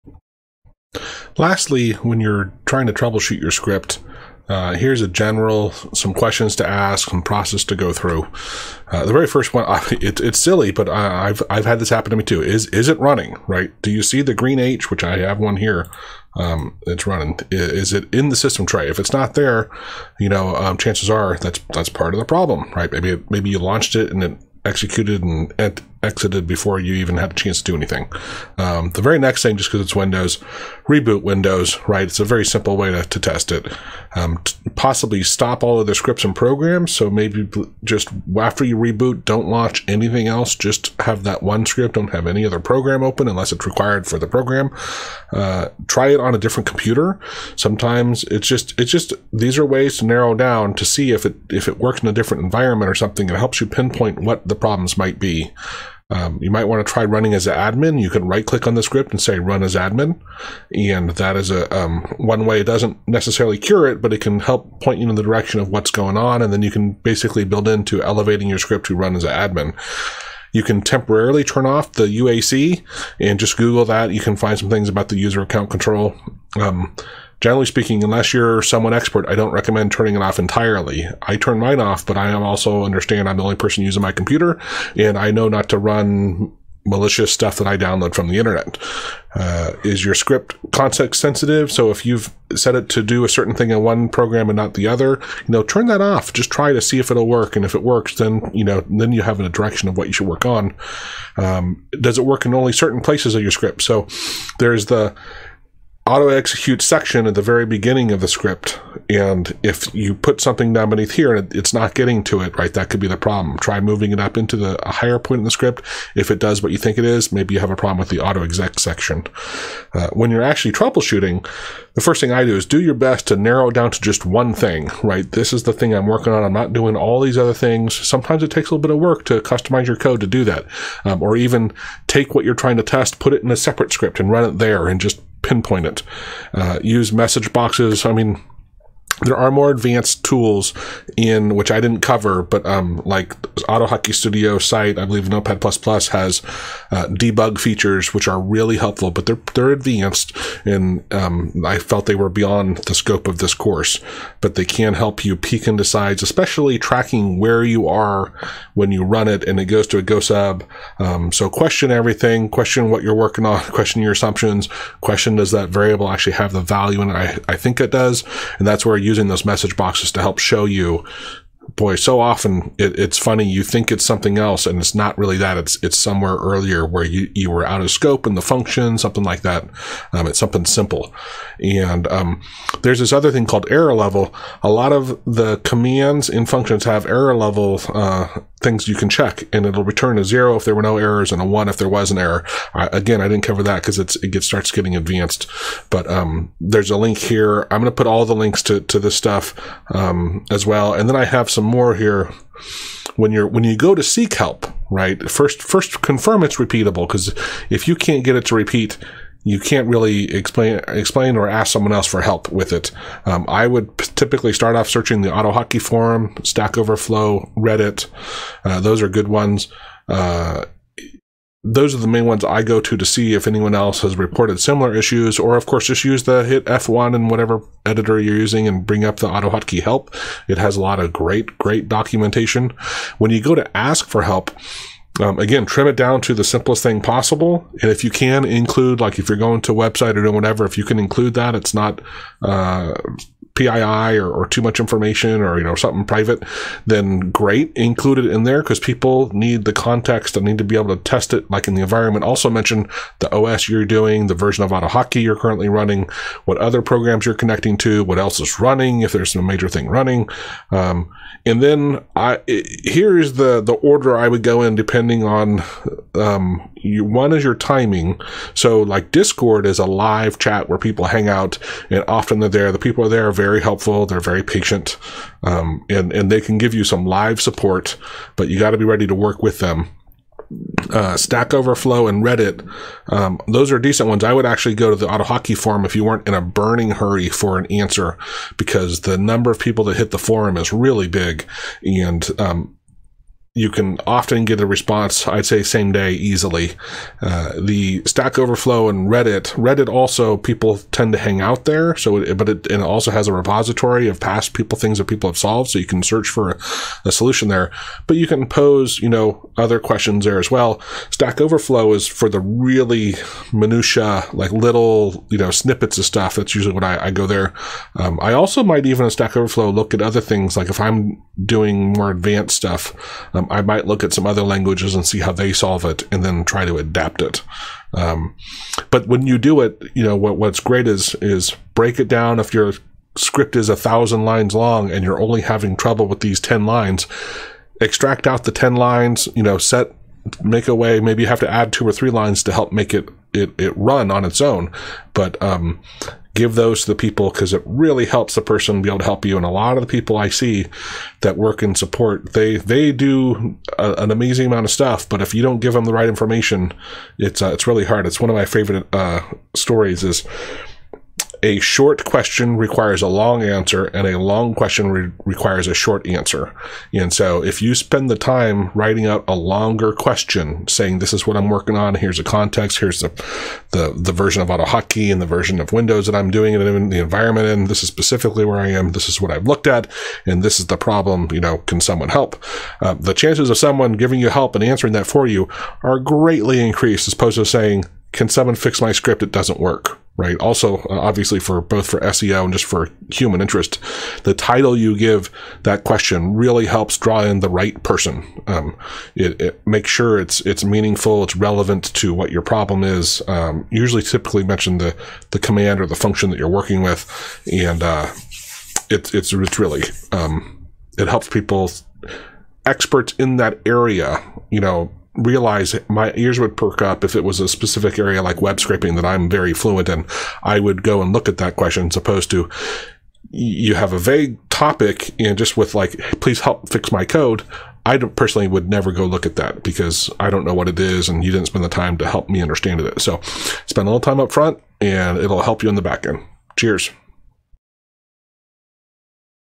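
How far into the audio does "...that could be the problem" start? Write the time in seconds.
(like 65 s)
112 s.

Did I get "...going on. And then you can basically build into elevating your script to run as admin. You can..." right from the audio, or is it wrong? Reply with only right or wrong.
right.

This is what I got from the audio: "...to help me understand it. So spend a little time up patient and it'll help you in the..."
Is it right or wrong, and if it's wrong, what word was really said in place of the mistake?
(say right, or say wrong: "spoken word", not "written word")
wrong: "front", not "patient".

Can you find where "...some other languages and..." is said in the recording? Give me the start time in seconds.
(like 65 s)
324 s.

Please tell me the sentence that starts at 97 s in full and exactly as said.
And if it works, then, you know, then you have a direction of what you should work on.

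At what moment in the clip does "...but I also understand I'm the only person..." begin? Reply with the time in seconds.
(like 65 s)
82 s.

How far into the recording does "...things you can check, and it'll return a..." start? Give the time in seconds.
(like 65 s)
188 s.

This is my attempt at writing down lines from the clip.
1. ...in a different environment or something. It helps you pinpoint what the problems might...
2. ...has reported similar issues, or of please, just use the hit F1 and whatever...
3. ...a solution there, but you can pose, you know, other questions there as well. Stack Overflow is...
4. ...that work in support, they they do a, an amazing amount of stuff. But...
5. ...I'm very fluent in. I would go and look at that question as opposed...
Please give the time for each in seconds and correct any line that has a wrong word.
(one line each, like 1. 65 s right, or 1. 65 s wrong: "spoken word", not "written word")
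1. 52 s right
2. 224 s wrong: "course", not "please"
3. 307 s right
4. 351 s right
5. 419 s right.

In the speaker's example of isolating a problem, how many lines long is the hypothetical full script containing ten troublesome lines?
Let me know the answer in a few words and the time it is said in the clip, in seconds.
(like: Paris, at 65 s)
1000, at 333 s.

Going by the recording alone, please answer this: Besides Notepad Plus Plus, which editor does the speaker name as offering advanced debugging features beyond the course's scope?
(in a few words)
AutoHotkey Studio.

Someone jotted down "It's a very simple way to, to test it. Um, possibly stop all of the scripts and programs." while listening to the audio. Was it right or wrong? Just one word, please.
right.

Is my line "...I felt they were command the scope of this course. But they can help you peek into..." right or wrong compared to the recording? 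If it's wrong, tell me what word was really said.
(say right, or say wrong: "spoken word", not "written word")
wrong: "beyond", not "command".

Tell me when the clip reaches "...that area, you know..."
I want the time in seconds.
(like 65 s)
413 s.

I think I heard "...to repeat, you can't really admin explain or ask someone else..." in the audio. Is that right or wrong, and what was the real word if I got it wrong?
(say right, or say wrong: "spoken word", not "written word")
wrong: "explain", not "admin".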